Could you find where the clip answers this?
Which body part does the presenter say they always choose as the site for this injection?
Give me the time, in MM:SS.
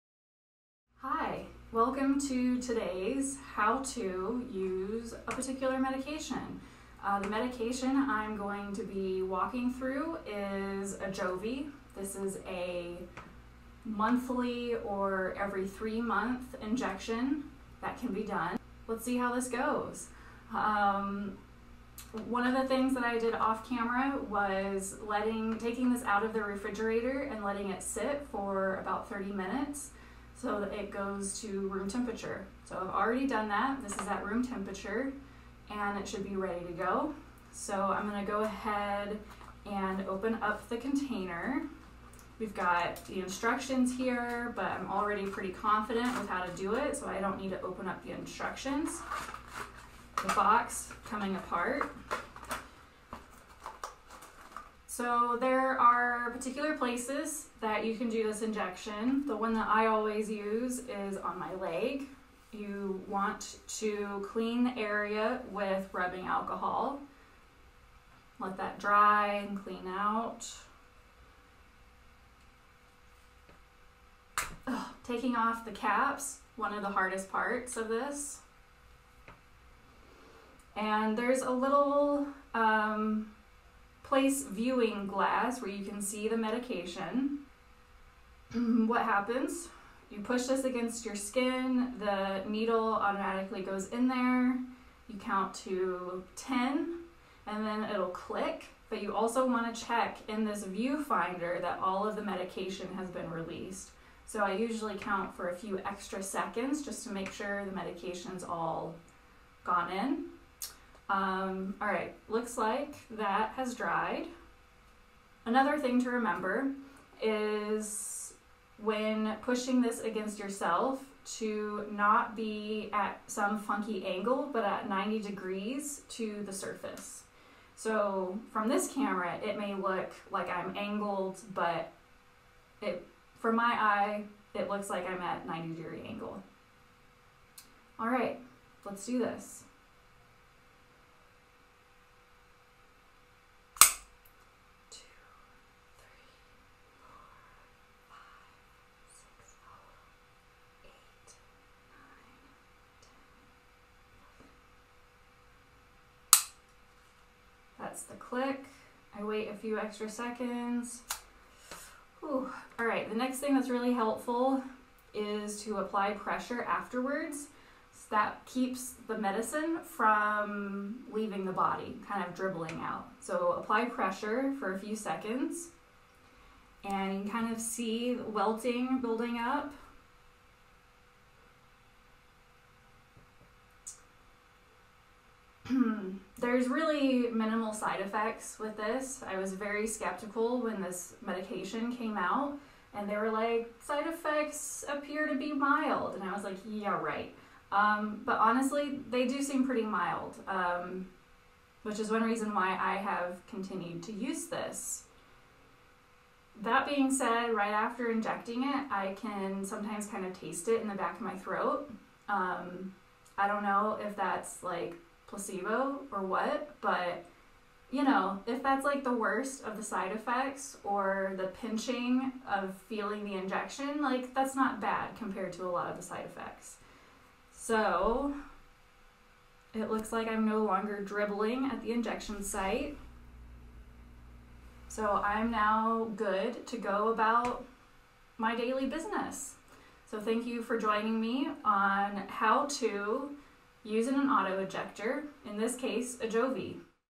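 01:01.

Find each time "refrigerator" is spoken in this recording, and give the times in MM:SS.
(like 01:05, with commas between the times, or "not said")
00:26.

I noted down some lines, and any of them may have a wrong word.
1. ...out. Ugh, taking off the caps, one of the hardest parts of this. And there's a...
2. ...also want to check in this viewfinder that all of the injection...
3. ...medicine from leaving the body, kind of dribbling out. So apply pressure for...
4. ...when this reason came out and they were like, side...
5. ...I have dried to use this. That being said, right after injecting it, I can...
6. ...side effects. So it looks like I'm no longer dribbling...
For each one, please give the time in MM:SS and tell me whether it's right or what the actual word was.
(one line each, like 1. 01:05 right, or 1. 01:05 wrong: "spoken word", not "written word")
1. 01:09 right
2. 01:39 wrong: "medication", not "injection"
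3. 02:49 right
4. 03:10 wrong: "medication", not "reason"
5. 03:22 wrong: "continued", not "dried"
6. 03:46 right.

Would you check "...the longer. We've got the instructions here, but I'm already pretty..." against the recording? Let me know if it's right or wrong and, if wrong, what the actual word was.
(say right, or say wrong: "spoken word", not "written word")
wrong: "container", not "longer".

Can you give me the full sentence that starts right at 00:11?
This is a monthly or every three month injection that can be done.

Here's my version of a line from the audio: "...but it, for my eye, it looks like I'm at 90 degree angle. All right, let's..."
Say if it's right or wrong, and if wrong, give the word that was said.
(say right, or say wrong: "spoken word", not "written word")
right.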